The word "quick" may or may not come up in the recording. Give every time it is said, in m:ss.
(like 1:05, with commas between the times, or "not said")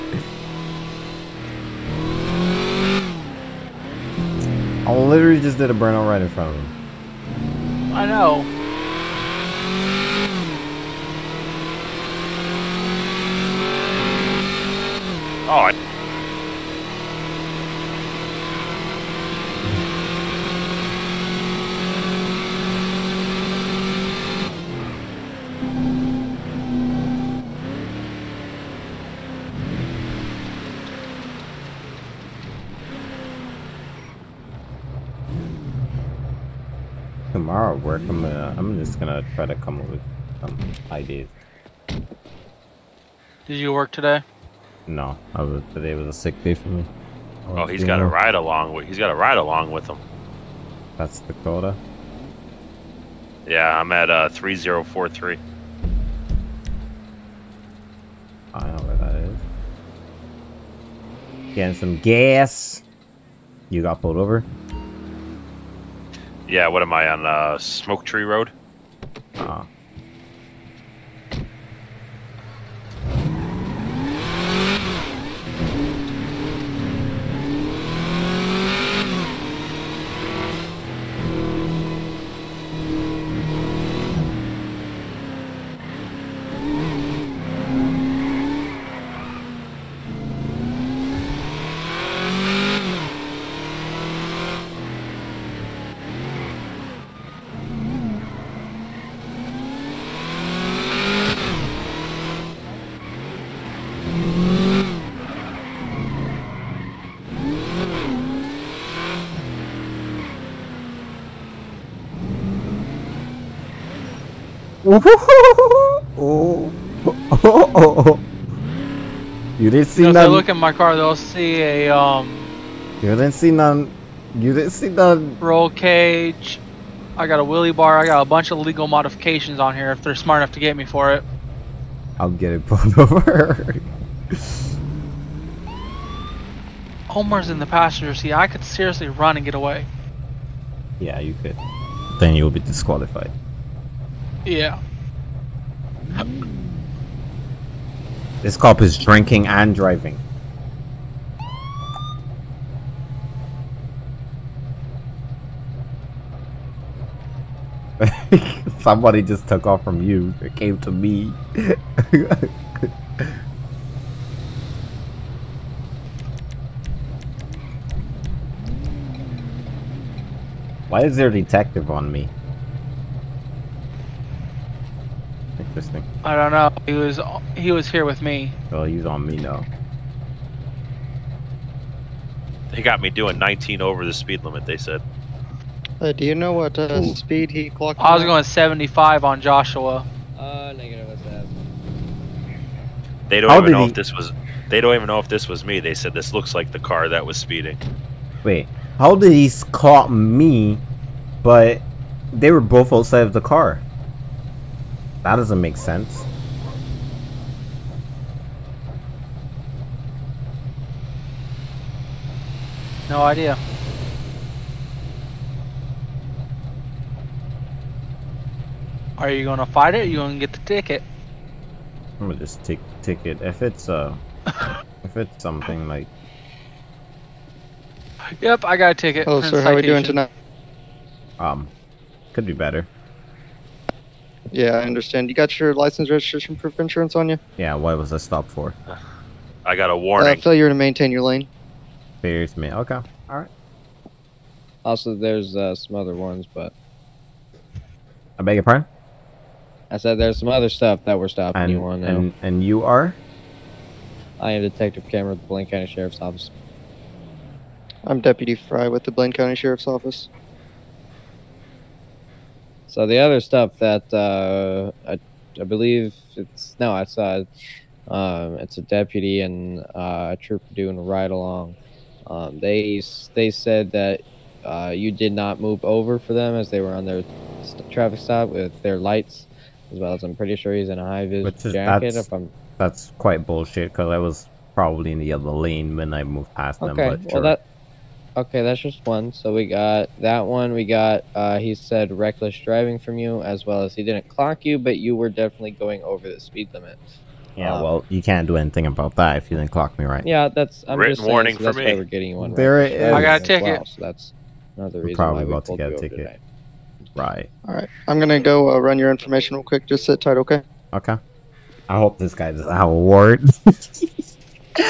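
5:09.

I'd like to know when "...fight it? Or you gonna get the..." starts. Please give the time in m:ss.
3:39.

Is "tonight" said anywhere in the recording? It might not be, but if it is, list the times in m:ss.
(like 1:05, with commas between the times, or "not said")
3:50, 5:06.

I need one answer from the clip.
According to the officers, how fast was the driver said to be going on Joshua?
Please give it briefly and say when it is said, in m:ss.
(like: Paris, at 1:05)
75, at 3:08.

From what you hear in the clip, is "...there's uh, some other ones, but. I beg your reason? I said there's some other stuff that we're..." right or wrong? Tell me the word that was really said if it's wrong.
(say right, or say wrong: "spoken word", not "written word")
wrong: "pardon", not "reason".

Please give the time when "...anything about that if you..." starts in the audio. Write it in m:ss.
4:58.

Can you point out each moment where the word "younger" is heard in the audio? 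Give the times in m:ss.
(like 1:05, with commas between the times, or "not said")
not said.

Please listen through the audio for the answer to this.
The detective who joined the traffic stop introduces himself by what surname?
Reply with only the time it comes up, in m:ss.
4:15.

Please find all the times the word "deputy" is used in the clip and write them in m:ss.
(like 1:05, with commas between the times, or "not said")
4:18, 4:28.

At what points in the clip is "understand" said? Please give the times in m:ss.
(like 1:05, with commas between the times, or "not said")
3:54.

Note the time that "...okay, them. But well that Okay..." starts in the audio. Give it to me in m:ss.
4:46.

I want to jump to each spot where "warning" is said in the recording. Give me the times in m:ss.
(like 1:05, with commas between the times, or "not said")
3:59, 5:01.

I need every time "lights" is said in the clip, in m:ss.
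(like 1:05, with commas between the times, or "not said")
4:38.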